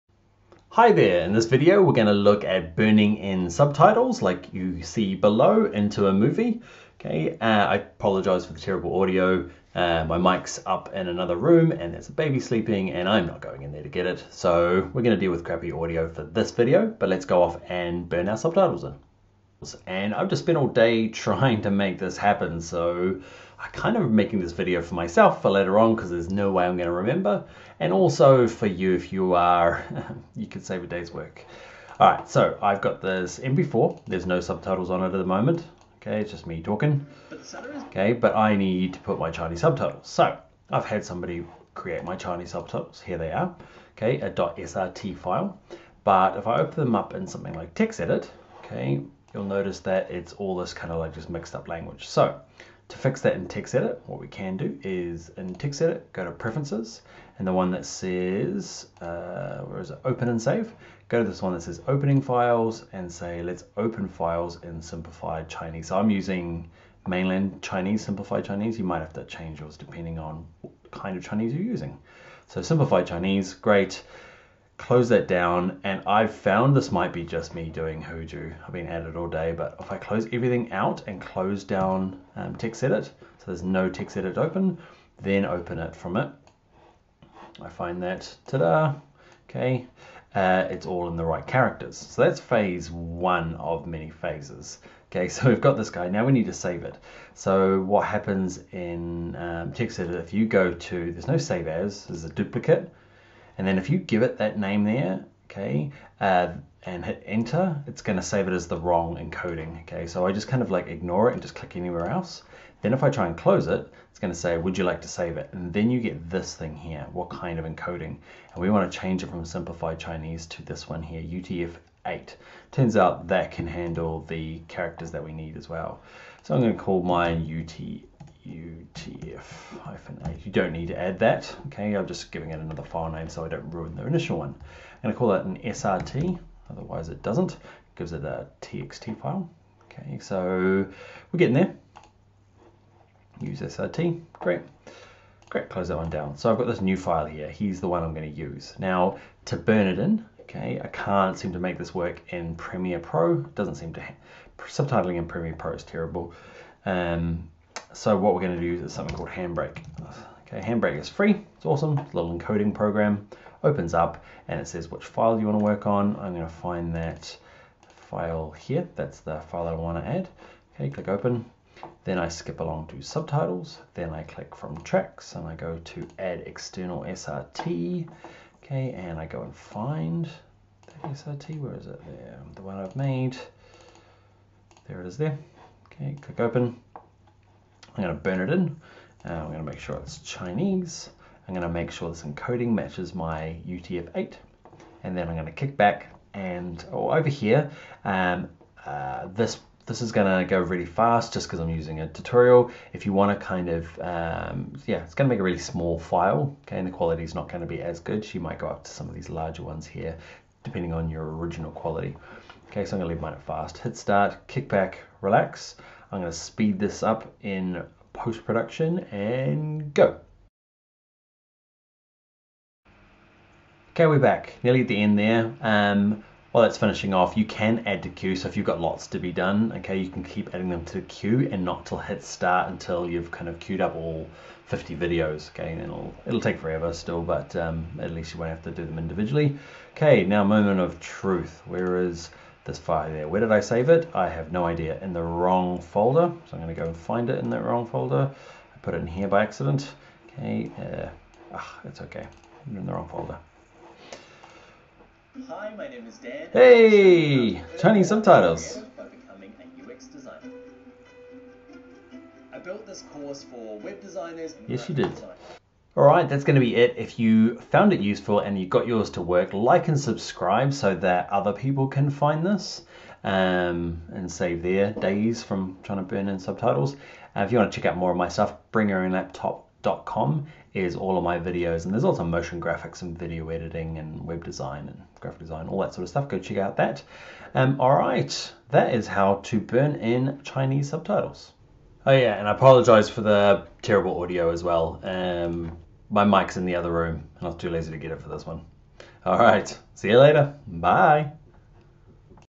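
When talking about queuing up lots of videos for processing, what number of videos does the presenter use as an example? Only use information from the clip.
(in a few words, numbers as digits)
50.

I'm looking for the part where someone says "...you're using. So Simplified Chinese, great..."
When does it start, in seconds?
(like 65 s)
71 s.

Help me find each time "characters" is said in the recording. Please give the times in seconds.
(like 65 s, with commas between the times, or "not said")
91 s, 124 s.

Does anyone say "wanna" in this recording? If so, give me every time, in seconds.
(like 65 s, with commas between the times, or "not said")
203 s.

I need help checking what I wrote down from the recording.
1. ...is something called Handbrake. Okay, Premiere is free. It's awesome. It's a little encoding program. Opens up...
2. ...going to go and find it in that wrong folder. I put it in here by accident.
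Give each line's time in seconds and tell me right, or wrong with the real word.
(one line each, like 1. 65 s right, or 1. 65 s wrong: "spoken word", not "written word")
1. 158 s wrong: "Handbrake", not "Premiere"
2. 246 s right.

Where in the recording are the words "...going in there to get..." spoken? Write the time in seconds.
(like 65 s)
13 s.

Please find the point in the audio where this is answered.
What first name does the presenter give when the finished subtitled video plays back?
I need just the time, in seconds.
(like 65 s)
256 s.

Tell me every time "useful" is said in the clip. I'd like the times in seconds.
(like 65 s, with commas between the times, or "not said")
267 s.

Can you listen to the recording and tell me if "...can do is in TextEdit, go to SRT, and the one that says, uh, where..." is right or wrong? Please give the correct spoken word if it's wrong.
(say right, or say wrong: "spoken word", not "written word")
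wrong: "Preferences", not "SRT".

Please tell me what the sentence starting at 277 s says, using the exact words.
Uh, if you want to check out more of my stuff, bringyourownlaptop.com is all of my videos.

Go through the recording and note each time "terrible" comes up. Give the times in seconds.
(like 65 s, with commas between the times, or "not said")
8 s, 155 s, 293 s.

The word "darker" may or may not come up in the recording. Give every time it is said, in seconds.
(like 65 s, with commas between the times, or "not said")
not said.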